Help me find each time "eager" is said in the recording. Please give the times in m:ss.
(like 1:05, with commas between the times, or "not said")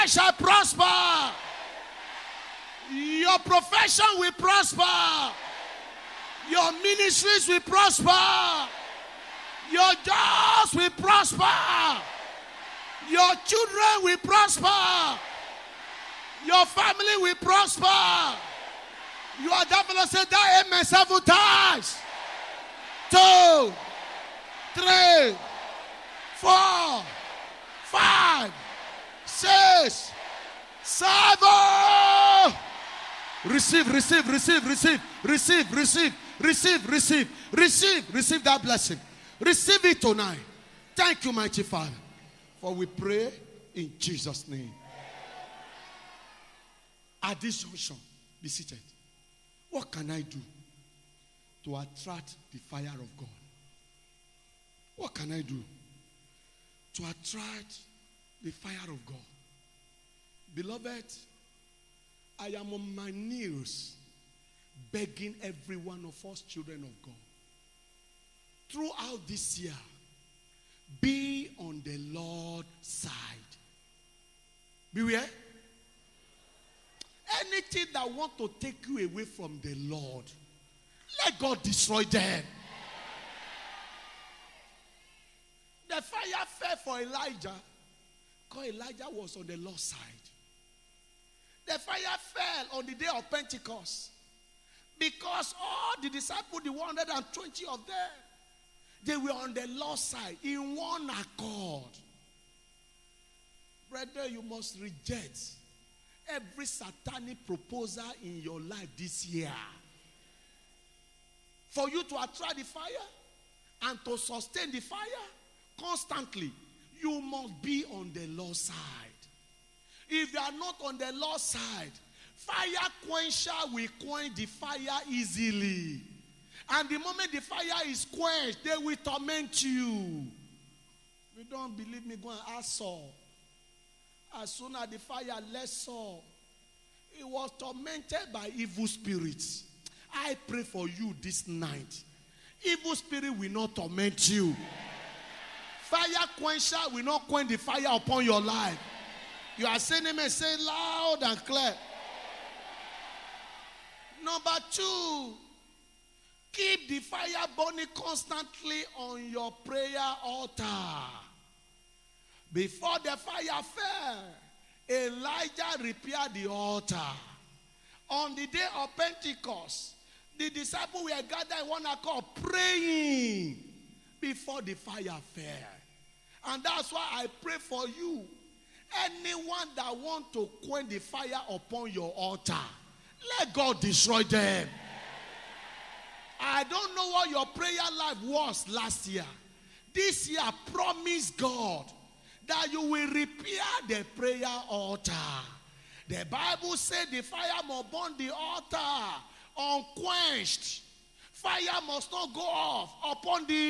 not said.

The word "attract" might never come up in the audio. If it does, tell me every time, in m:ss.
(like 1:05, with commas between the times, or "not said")
0:51, 0:57, 1:52.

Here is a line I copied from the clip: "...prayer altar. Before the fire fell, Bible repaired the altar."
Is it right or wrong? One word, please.
wrong.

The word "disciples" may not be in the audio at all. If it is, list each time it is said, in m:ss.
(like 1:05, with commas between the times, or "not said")
1:36, 2:50.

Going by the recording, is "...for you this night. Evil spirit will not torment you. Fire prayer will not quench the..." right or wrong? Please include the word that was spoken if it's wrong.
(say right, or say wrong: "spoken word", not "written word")
wrong: "quencher", not "prayer".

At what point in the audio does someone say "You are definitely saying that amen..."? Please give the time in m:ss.
0:19.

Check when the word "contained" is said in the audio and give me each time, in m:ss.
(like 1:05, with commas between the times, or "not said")
not said.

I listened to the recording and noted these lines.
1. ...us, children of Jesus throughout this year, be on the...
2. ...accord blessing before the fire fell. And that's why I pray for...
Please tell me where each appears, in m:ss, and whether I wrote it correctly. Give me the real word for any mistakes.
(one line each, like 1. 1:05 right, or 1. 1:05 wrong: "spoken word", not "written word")
1. 1:06 wrong: "God", not "Jesus"
2. 2:51 wrong: "praying", not "blessing".